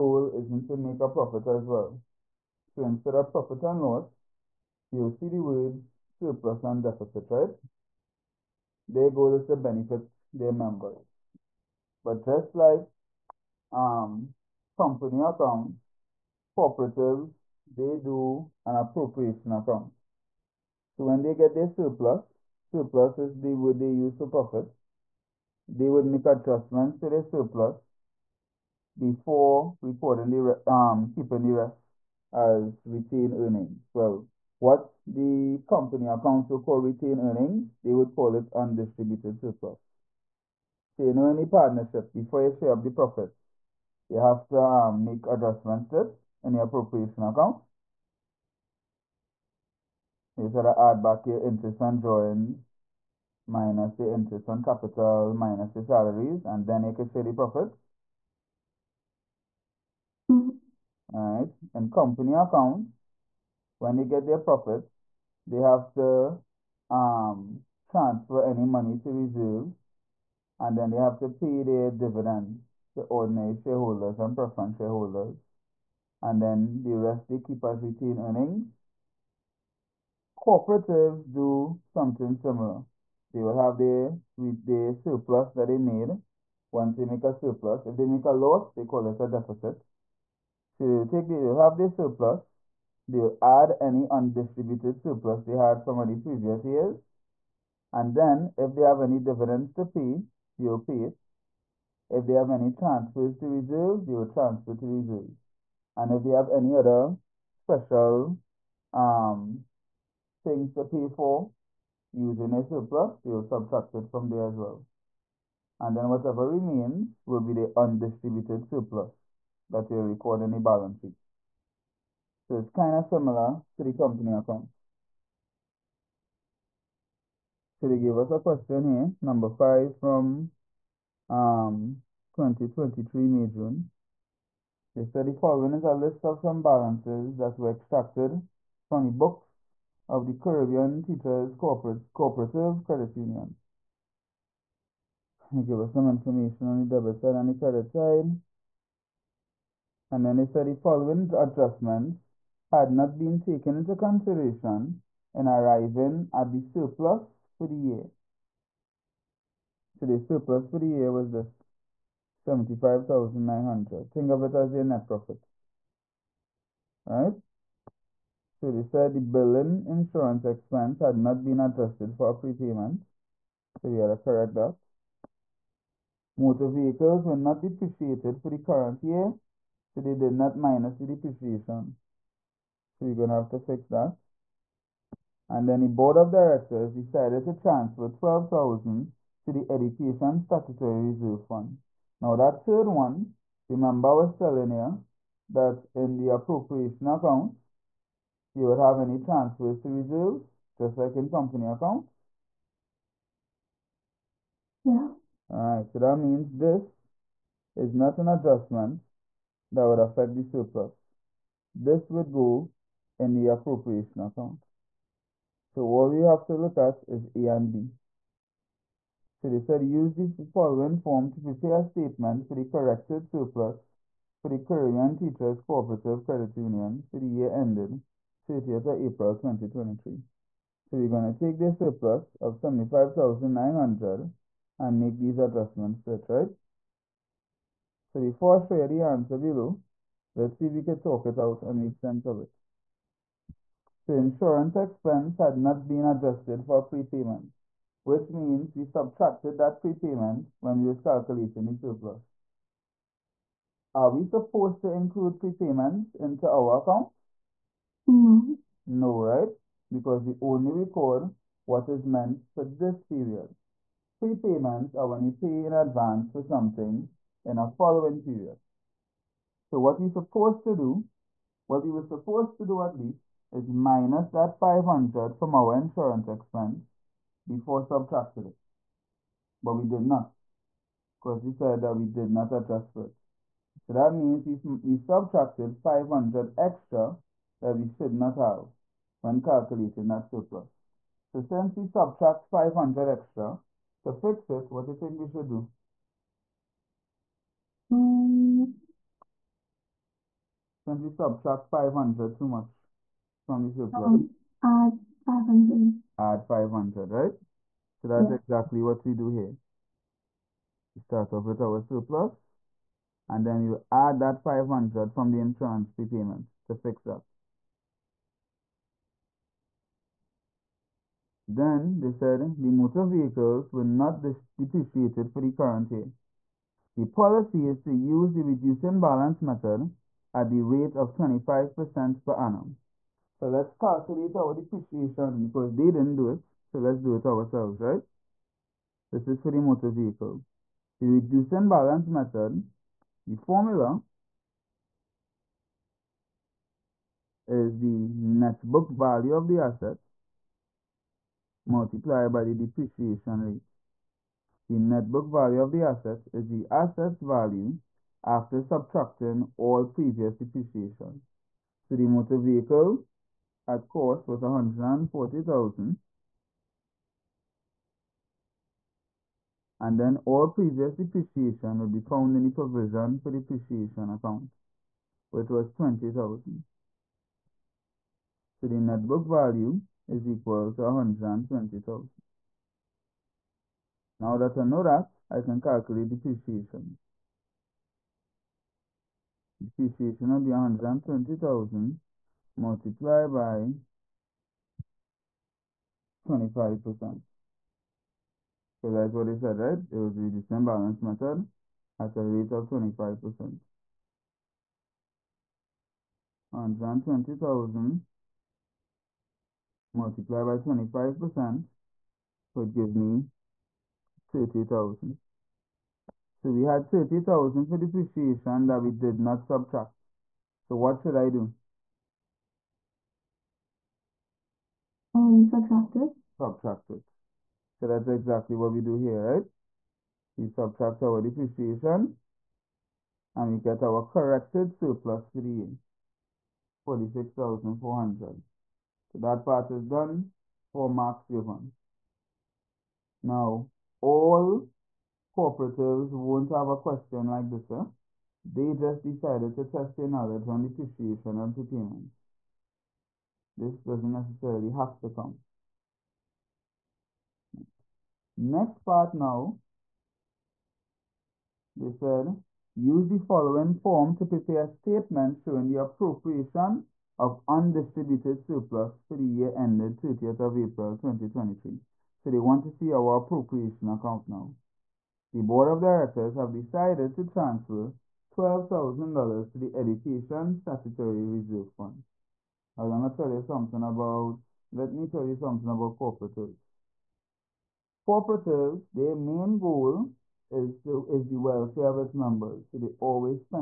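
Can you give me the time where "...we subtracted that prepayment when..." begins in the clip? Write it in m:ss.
4:08.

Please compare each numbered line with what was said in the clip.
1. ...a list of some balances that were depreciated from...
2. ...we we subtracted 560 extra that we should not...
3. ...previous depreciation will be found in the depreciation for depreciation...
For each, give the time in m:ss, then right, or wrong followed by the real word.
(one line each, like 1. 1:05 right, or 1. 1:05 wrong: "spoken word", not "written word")
1. 2:15 wrong: "extracted", not "depreciated"
2. 4:44 wrong: "500", not "560"
3. 6:10 wrong: "provision", not "depreciation".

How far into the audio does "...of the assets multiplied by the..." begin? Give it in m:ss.
5:49.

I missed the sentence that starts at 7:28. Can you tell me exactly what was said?
They just decided to test their knowledge on depreciation and prepayments.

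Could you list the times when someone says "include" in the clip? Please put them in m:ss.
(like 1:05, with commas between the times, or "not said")
4:14.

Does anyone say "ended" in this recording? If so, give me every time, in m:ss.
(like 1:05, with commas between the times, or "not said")
3:47, 7:49.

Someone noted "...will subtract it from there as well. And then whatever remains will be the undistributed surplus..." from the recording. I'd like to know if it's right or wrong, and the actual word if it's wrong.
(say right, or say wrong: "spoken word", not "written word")
right.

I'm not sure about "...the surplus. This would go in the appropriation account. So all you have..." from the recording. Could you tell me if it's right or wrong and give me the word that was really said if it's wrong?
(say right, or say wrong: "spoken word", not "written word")
right.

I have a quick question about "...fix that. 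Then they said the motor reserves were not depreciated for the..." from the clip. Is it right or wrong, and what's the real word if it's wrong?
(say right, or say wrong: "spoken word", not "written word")
wrong: "vehicles", not "reserves".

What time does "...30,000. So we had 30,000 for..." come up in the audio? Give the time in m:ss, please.
6:54.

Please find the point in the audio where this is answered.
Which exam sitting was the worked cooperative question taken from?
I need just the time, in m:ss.
2:12.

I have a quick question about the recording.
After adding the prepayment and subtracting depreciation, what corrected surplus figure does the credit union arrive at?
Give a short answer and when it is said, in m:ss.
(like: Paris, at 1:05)
46,400, at 7:16.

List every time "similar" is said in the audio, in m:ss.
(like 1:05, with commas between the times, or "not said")
1:22, 2:03.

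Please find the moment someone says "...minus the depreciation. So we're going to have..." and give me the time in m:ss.
3:00.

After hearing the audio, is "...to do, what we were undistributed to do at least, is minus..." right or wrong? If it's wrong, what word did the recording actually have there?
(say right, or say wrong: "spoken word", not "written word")
wrong: "supposed", not "undistributed".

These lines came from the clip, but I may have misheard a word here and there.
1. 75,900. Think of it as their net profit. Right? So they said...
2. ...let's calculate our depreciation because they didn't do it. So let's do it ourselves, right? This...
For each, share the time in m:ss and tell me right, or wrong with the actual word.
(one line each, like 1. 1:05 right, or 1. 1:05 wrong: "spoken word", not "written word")
1. 2:42 right
2. 5:33 right.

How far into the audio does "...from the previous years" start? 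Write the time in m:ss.
1:35.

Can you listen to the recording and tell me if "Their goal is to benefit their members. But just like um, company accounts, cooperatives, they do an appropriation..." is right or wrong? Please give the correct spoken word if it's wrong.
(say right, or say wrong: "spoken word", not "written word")
right.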